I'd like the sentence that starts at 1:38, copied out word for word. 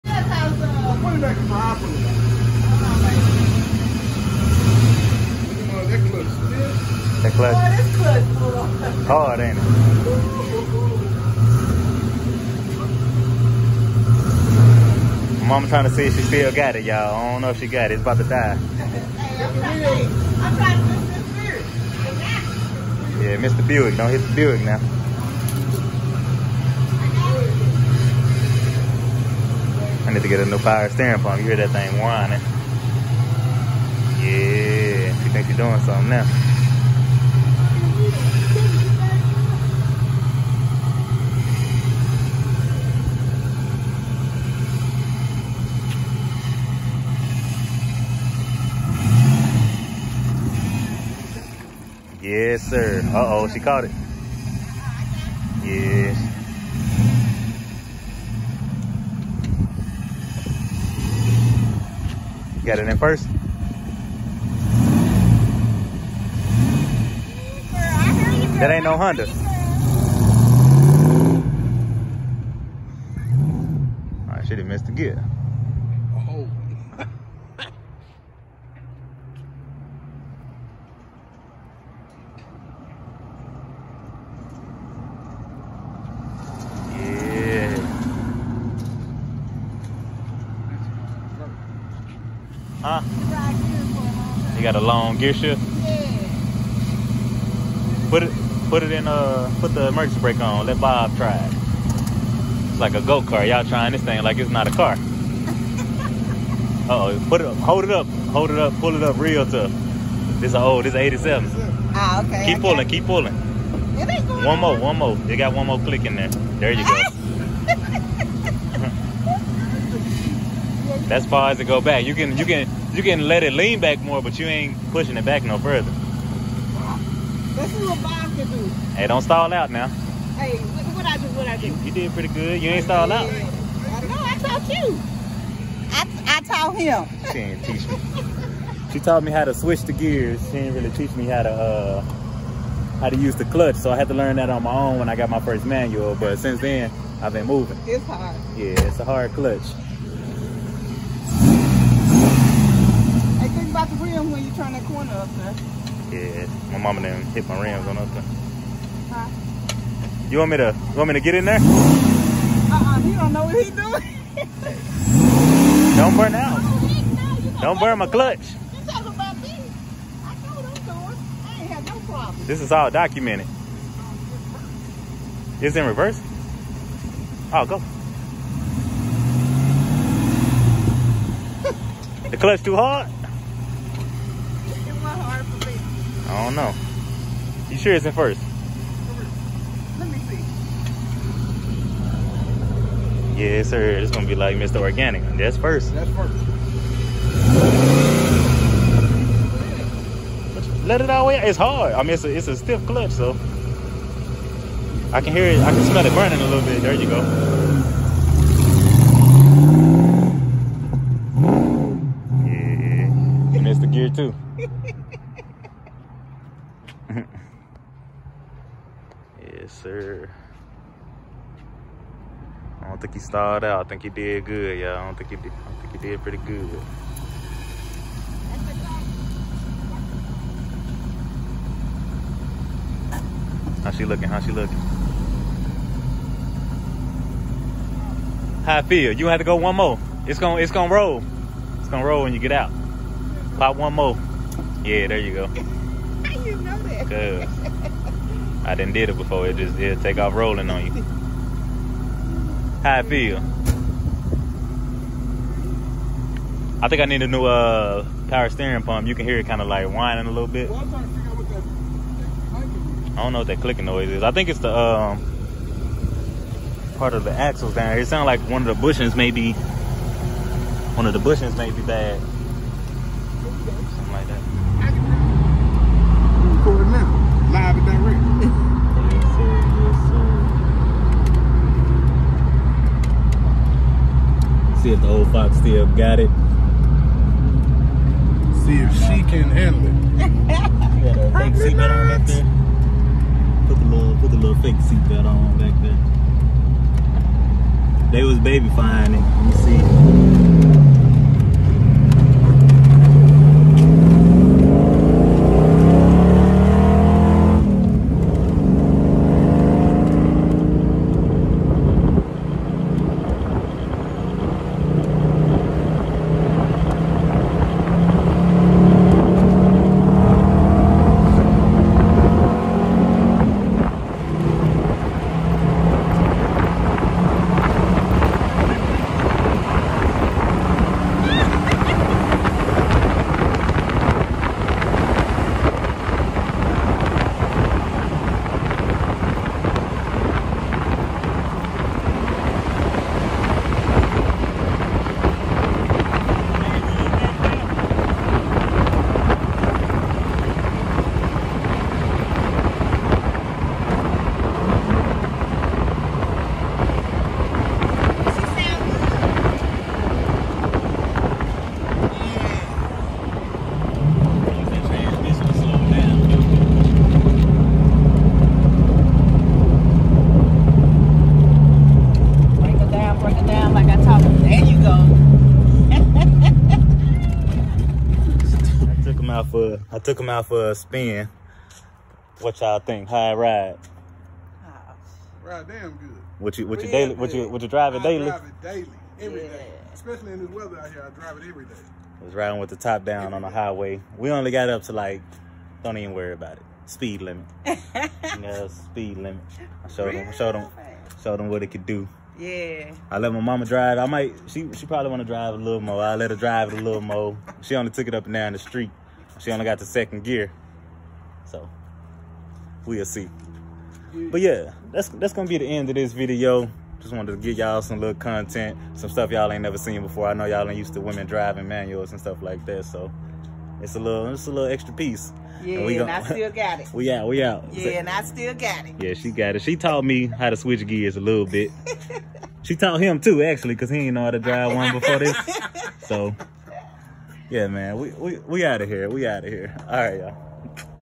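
Put it put it in a, uh, put the emergency brake on.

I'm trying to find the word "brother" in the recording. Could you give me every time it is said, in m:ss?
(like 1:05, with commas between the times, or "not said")
not said.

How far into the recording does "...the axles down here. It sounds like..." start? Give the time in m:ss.
4:27.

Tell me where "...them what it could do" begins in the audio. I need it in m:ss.
6:41.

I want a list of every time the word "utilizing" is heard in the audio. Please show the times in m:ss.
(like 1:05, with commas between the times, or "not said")
not said.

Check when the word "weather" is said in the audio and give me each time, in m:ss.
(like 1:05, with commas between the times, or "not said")
6:30.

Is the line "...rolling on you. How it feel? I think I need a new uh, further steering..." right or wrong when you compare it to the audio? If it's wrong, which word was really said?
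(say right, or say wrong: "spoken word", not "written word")
wrong: "power", not "further".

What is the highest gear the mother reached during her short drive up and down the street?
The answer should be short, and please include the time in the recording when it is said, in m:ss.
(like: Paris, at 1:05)
second gear, at 6:49.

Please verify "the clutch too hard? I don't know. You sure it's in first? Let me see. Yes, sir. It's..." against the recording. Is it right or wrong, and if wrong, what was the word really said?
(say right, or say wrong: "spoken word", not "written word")
right.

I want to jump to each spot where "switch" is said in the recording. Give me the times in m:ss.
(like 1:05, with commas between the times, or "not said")
2:19, 7:10.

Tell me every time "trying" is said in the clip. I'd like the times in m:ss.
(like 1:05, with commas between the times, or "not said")
0:15, 0:20, 1:43.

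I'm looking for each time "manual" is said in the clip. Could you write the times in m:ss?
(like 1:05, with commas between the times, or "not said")
2:25, 7:01.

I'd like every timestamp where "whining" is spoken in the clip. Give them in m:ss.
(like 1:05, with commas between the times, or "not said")
0:31, 4:19.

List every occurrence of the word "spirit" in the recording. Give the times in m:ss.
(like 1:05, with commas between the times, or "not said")
0:21.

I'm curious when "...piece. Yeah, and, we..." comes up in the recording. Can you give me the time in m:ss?
7:04.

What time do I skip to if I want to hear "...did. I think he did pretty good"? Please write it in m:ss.
3:45.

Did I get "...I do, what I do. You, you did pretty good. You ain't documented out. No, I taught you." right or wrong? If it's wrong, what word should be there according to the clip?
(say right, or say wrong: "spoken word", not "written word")
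wrong: "stalled", not "documented".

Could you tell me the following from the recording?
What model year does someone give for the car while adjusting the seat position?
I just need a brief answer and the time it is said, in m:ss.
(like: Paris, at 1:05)
1987, at 1:50.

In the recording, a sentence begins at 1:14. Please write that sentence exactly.
Alright, should have missed the gear.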